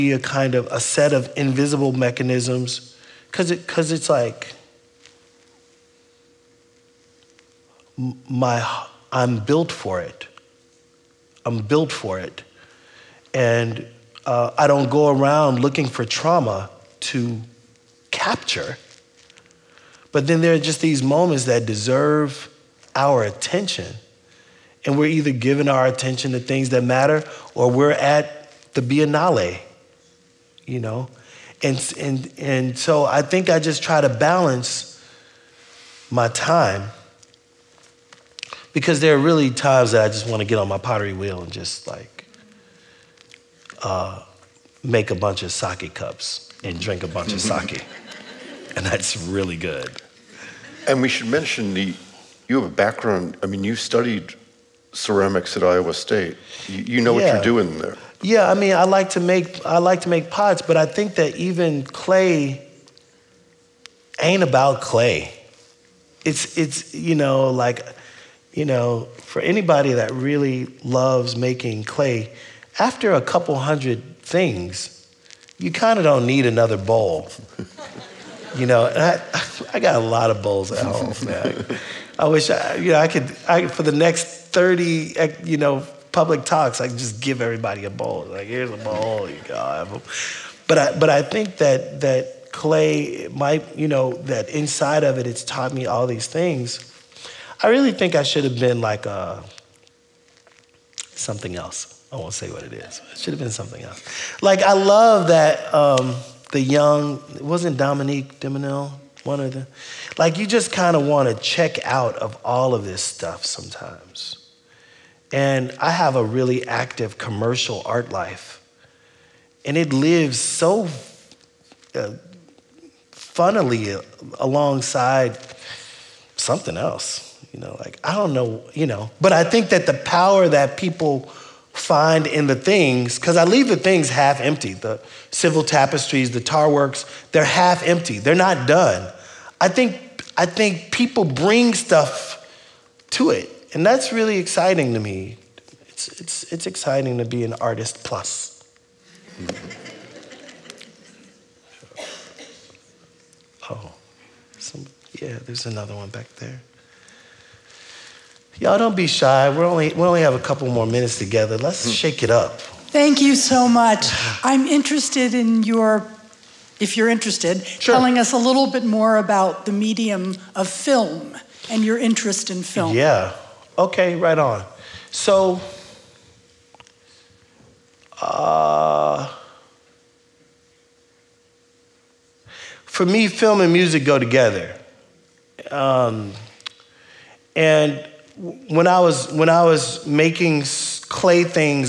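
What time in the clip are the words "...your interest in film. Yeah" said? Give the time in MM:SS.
02:51.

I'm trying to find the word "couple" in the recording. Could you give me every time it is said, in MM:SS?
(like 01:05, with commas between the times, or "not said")
01:13, 02:40.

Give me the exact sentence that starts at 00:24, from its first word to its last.
And we're either giving our attention to things that matter or we're at the Biennale, you know?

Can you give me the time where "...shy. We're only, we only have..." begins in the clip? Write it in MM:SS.
02:39.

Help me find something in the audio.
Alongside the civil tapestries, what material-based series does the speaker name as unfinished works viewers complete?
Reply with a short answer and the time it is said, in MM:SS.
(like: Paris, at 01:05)
Tar works, at 02:16.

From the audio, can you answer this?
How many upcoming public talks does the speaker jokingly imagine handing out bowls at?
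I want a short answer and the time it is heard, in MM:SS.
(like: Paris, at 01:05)
30, at 01:24.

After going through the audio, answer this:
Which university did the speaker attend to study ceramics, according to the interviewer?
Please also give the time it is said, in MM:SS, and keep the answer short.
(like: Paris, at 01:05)
Iowa State, at 00:55.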